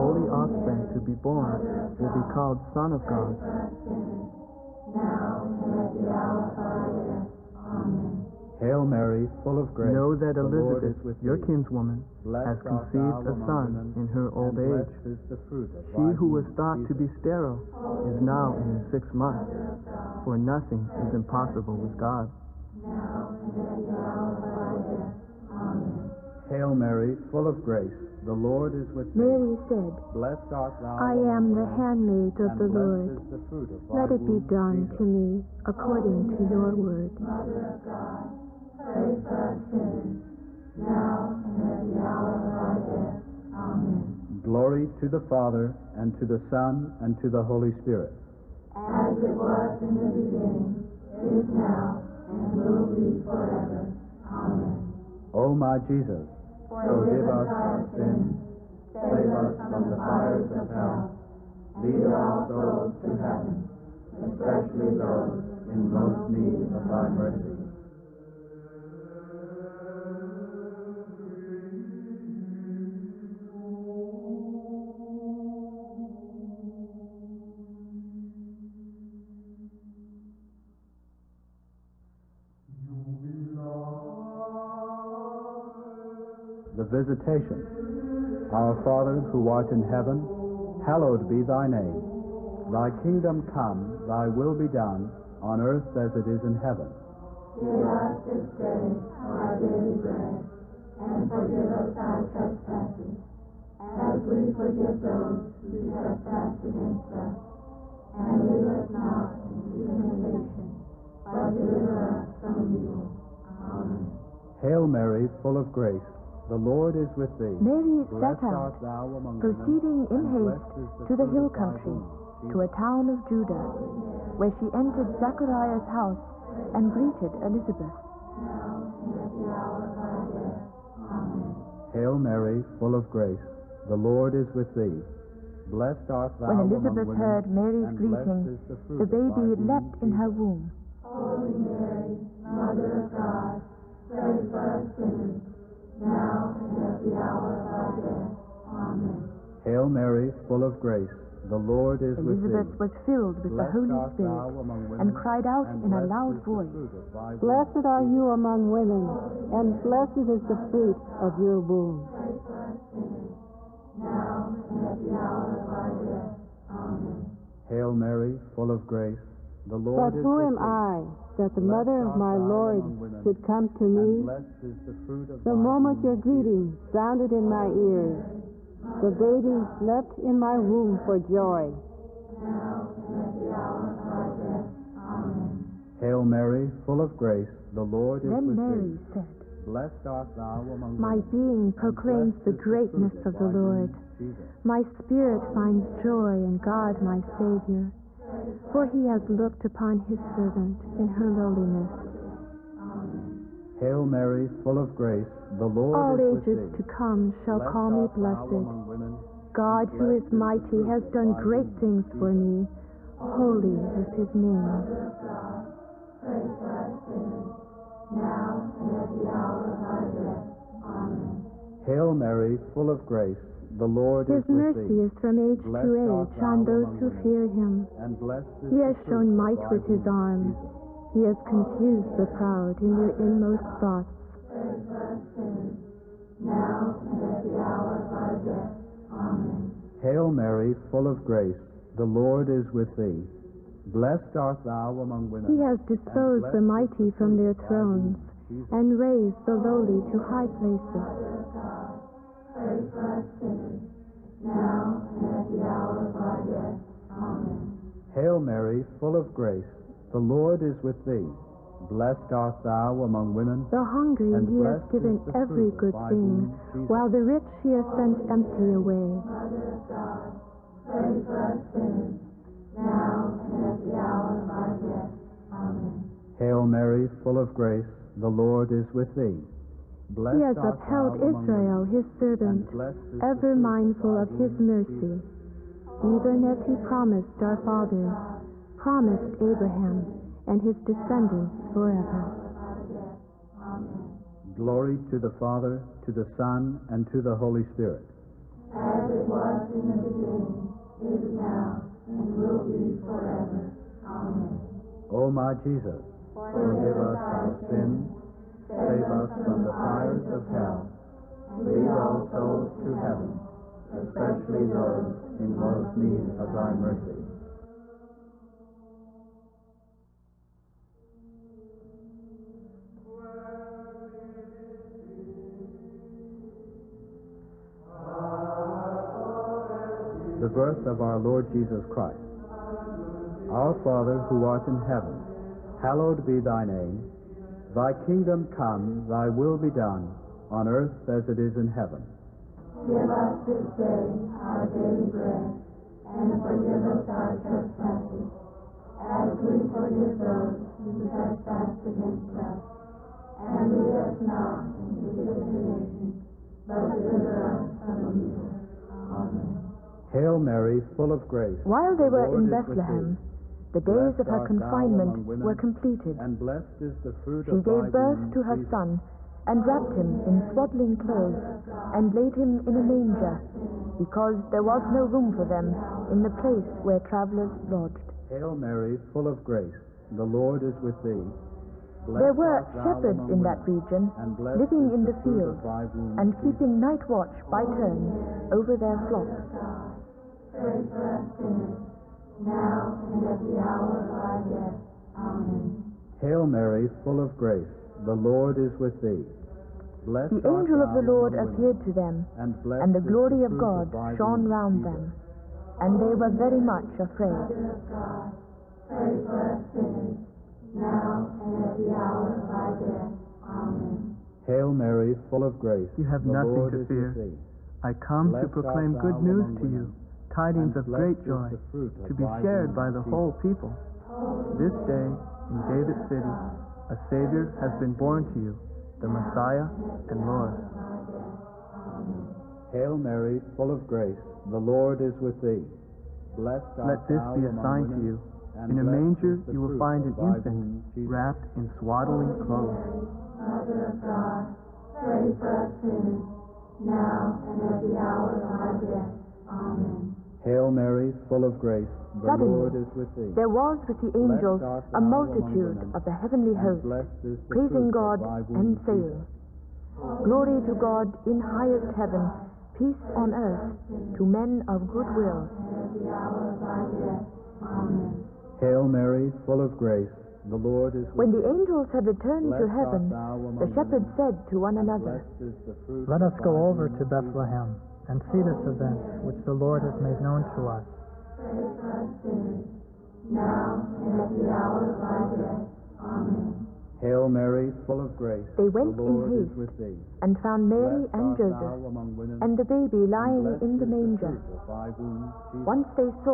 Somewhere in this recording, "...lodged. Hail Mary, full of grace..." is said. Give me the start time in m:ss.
6:17.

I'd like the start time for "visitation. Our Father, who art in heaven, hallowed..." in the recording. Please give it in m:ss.
1:27.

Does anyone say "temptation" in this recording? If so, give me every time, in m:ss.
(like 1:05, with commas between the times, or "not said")
1:49, 5:55.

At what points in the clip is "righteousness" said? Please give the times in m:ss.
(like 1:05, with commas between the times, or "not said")
not said.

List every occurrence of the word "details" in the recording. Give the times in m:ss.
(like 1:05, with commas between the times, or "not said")
not said.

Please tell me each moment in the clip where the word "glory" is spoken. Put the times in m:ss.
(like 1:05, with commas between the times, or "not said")
0:44, 4:54, 6:42, 7:40.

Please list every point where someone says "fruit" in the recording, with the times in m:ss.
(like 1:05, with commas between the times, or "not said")
2:40, 6:07.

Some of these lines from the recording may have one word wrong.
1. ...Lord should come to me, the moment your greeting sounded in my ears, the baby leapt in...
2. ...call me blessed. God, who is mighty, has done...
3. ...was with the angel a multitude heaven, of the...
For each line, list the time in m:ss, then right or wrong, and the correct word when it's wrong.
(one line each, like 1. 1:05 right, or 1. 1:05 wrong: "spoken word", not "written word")
1. 2:52 right
2. 3:27 right
3. 7:33 wrong: "women", not "heaven".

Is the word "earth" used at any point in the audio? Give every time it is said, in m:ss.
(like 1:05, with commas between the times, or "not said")
1:35, 5:40, 7:43.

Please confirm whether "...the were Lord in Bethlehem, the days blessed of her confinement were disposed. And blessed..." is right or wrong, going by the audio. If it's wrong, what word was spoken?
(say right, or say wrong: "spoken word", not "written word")
wrong: "completed", not "disposed".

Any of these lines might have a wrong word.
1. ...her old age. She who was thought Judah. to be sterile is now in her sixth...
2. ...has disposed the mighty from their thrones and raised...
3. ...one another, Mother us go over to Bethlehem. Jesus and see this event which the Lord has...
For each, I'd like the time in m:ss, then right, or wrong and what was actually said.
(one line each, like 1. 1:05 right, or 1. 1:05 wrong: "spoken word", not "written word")
1. 0:14 wrong: "Jesus", not "Judah"
2. 4:05 right
3. 7:54 wrong: "Let", not "Mother".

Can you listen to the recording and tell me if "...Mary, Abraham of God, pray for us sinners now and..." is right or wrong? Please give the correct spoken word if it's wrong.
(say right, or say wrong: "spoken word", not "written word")
wrong: "Mother", not "Abraham".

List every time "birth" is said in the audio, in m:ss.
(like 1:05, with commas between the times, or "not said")
5:30, 6:07.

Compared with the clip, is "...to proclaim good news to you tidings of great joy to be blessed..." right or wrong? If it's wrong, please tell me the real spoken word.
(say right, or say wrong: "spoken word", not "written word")
wrong: "shared", not "blessed".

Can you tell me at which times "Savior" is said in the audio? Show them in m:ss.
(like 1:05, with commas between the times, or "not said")
3:17, 7:06.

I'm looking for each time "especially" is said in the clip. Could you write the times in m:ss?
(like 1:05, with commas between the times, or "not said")
1:04, 5:13.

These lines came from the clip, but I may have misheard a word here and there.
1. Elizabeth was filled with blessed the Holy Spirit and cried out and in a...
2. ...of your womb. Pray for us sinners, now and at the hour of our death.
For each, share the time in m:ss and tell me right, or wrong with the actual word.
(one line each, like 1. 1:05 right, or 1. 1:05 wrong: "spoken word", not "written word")
1. 2:32 right
2. 2:41 right.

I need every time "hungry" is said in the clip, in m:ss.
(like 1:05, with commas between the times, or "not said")
4:23.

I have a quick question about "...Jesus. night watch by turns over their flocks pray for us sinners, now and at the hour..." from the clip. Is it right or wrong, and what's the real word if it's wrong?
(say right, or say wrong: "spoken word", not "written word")
right.